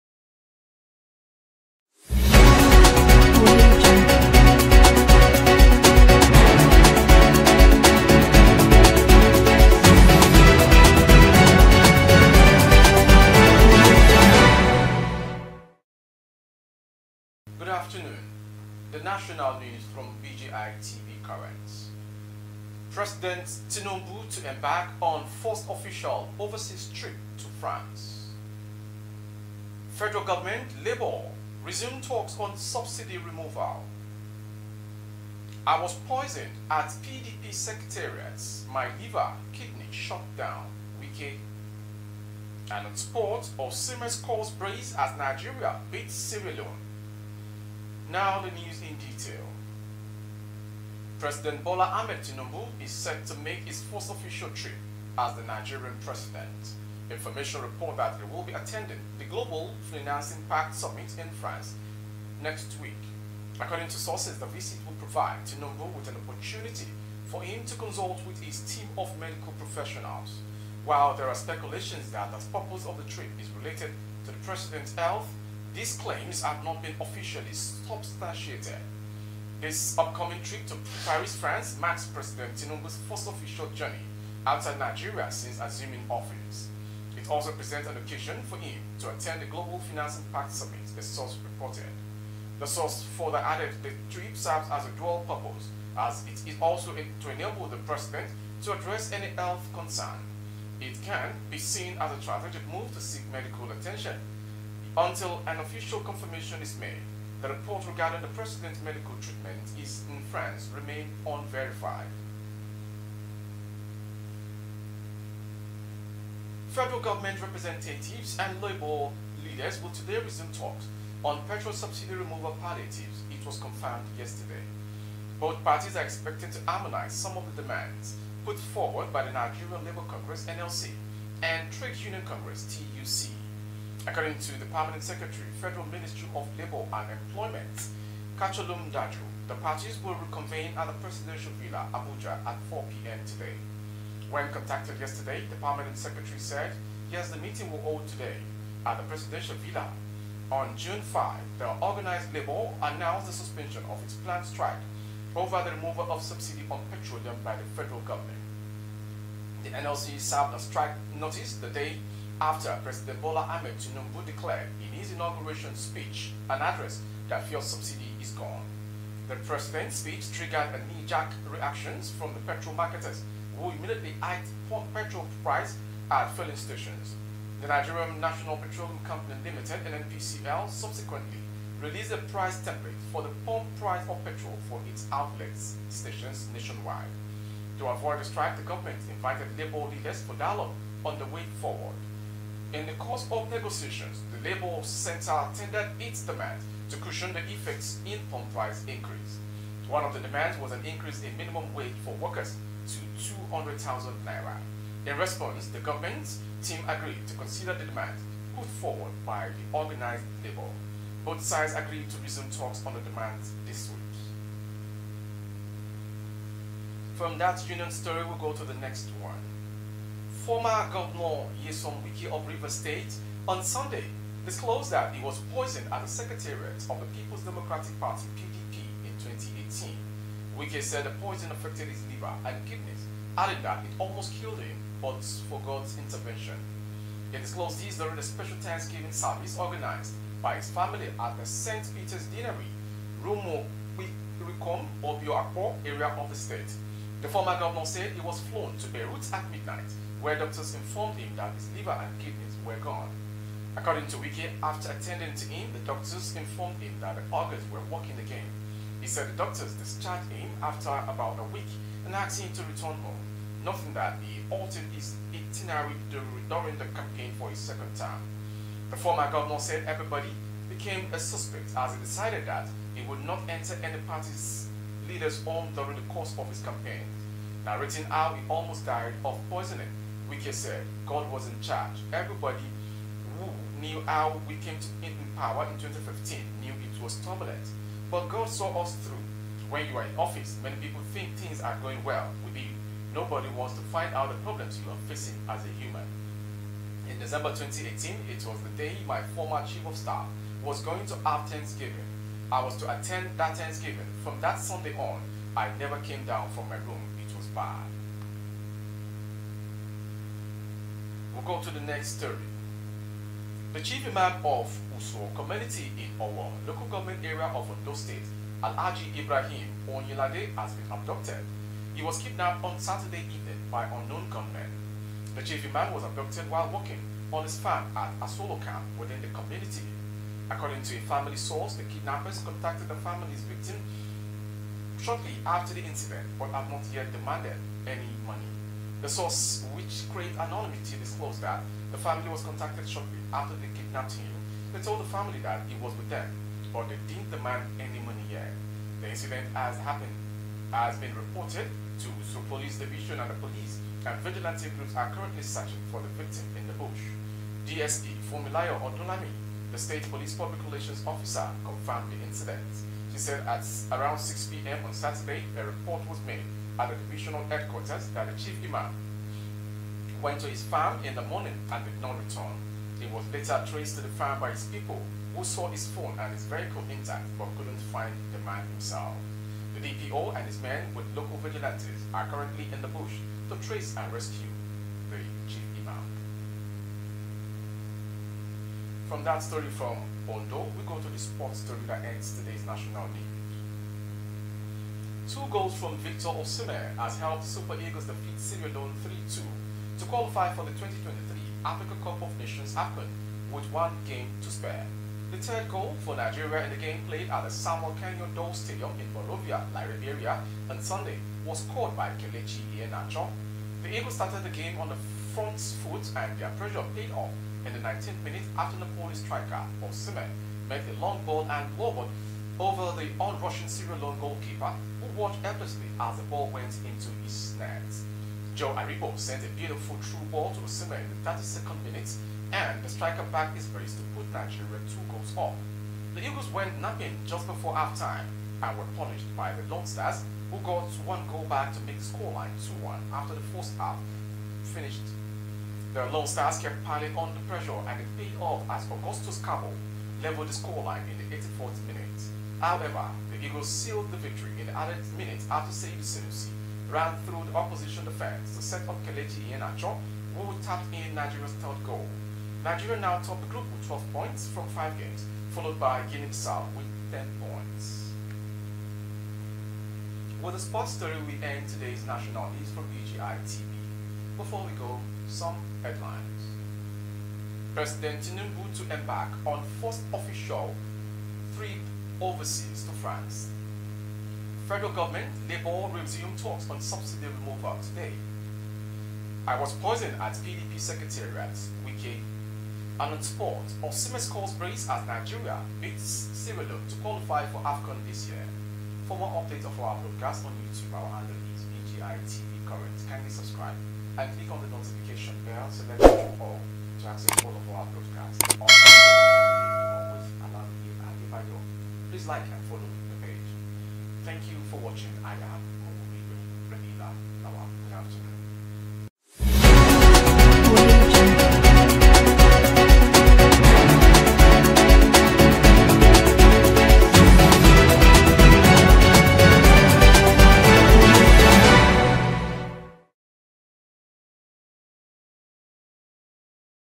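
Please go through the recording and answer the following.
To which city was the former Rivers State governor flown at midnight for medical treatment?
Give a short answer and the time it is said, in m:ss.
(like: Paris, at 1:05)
Beirut, at 4:08.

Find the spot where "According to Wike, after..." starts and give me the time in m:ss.
4:13.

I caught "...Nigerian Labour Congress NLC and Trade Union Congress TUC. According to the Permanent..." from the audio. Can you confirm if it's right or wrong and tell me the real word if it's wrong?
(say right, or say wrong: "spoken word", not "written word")
right.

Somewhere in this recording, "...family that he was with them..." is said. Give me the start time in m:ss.
5:45.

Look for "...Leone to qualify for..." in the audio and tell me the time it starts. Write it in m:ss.
8:16.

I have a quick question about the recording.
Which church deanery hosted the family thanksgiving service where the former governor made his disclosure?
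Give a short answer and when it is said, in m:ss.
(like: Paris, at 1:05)
St. Peter's Deanery, at 4:01.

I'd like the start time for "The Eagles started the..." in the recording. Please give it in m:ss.
6:53.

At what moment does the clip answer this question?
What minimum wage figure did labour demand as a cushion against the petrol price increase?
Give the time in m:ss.
3:23.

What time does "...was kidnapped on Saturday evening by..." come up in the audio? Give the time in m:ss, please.
5:22.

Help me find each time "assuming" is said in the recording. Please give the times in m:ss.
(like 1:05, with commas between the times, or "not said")
1:25.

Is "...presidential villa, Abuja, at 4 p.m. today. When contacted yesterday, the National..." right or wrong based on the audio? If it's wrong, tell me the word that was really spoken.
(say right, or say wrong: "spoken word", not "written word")
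wrong: "Permanent", not "National".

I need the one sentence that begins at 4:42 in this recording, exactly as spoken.
Everybody who knew how we came to in power in 2015 knew it was turbulent.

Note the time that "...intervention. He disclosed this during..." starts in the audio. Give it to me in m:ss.
3:55.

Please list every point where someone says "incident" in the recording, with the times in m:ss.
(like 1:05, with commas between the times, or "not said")
5:35, 5:49, 6:02.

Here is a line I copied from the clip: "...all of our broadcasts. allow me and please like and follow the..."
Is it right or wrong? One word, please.
right.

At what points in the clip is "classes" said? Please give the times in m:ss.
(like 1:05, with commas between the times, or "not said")
not said.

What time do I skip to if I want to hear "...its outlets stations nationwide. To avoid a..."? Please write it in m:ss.
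3:04.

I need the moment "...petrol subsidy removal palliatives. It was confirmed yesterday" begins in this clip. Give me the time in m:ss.
2:01.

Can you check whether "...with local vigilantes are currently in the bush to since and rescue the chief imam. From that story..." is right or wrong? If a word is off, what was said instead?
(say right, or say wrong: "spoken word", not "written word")
wrong: "trace", not "since".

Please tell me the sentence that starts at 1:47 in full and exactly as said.
The report regarding the president's medical treatment is in France remain unverified.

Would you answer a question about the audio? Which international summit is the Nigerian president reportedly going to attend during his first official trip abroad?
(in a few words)
Global Financing Pact Summit.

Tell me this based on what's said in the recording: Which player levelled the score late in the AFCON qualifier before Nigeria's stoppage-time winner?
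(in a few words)
Augustus Kargbo.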